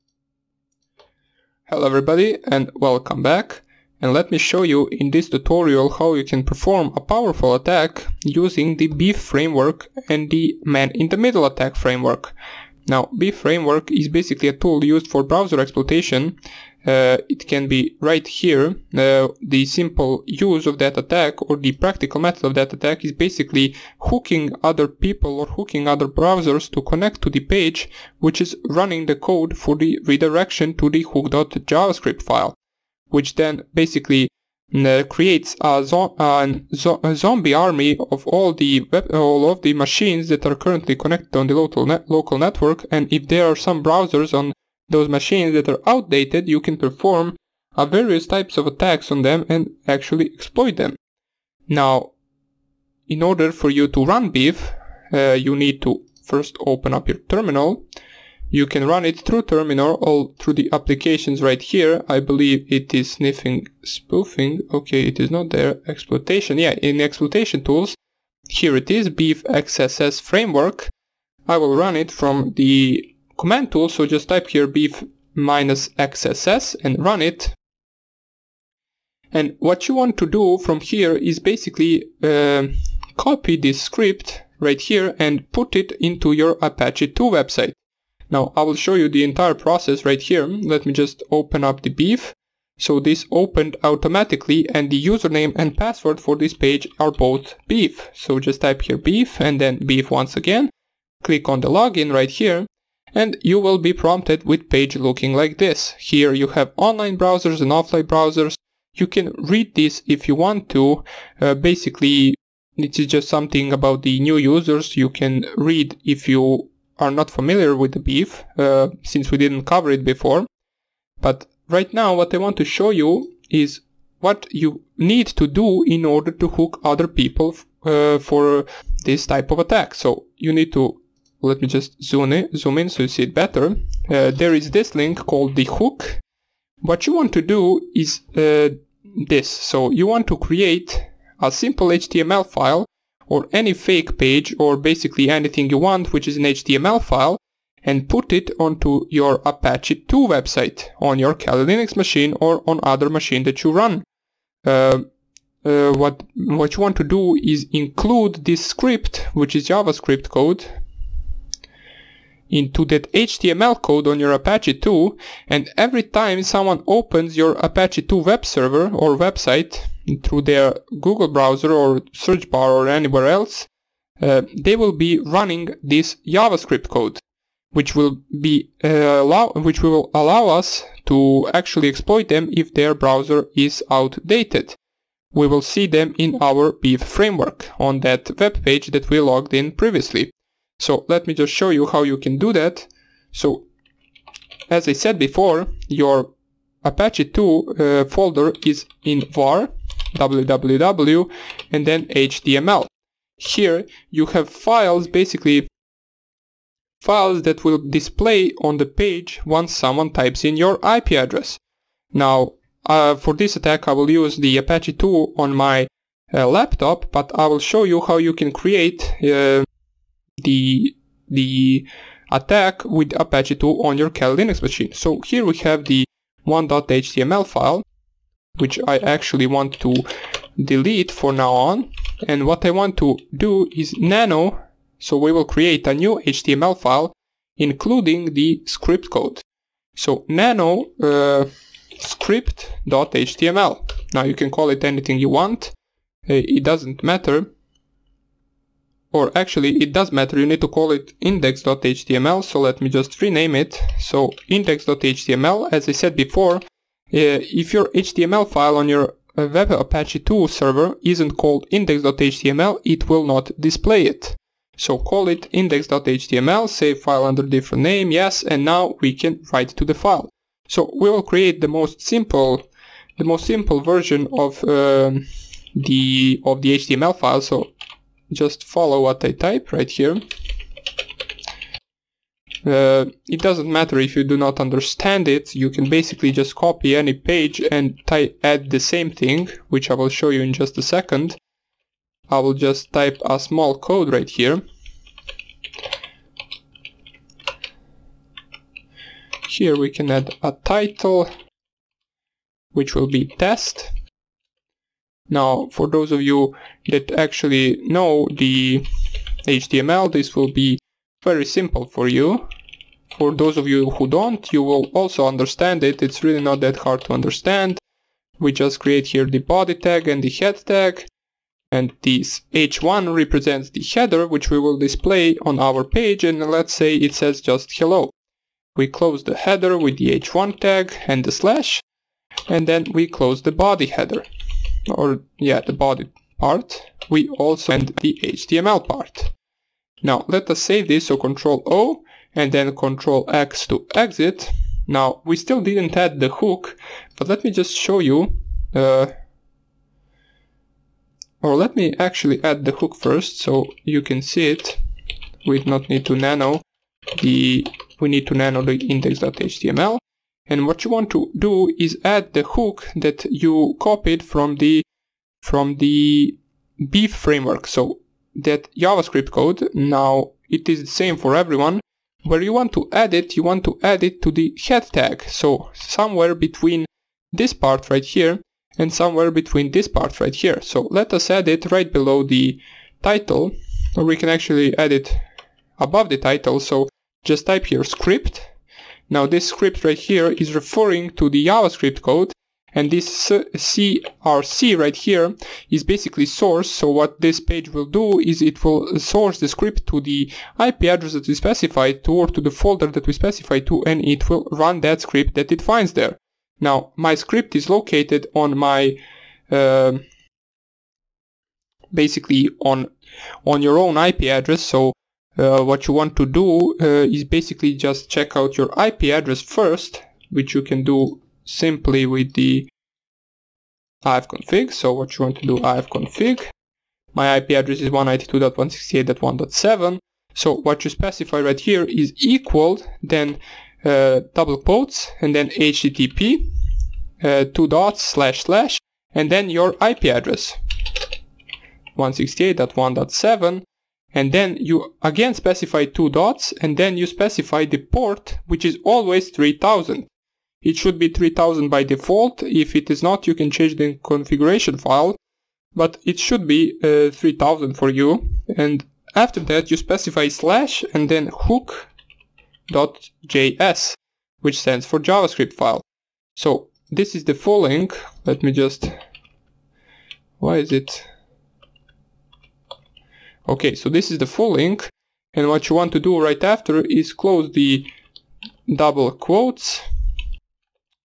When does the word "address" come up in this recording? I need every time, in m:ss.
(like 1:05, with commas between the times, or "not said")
3:31, 6:40, 6:54, 6:59, 7:07, 7:20.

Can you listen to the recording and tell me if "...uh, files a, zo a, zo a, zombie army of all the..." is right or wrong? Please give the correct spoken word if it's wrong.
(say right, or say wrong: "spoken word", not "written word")
wrong: "creates", not "files".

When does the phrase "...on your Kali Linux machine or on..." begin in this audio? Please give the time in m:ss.
2:30.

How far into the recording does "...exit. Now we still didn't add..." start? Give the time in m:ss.
5:43.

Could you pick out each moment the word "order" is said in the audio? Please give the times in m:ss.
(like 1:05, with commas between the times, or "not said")
0:53, 2:06.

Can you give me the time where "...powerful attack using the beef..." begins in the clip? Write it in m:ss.
0:06.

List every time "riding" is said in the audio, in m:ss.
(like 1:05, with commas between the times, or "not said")
not said.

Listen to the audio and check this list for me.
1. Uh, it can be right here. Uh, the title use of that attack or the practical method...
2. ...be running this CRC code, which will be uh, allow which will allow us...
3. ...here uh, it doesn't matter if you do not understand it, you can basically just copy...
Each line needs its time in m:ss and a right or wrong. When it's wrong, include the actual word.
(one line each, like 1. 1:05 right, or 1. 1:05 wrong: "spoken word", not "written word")
1. 0:16 wrong: "simple", not "title"
2. 2:54 wrong: "JavaScript", not "CRC"
3. 4:39 right.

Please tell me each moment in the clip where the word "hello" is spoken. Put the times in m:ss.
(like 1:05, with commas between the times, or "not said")
0:01, 5:27.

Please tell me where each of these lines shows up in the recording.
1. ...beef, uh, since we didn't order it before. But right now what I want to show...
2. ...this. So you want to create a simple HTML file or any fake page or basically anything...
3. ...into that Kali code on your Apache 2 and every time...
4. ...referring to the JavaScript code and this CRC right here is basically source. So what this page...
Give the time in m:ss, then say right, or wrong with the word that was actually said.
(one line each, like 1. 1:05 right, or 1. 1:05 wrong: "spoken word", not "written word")
1. 1:57 wrong: "cover", not "order"
2. 2:19 right
3. 2:42 wrong: "HTML", not "Kali"
4. 6:30 right.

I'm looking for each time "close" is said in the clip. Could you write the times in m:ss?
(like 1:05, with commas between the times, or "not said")
5:28, 5:33, 7:57.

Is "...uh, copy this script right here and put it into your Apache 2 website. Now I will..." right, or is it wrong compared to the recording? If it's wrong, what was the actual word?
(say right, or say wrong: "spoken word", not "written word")
right.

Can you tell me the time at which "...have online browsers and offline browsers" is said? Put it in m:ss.
1:46.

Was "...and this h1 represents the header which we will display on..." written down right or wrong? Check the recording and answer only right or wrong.
right.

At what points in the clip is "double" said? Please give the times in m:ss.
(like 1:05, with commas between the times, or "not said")
7:14, 7:58.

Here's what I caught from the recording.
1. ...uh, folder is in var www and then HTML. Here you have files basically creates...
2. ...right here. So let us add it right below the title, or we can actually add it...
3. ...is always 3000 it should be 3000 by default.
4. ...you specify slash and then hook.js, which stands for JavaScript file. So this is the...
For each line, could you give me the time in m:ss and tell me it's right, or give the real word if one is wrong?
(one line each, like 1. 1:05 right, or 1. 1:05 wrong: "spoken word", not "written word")
1. 3:17 wrong: "files", not "creates"
2. 6:20 right
3. 7:28 right
4. 7:39 right.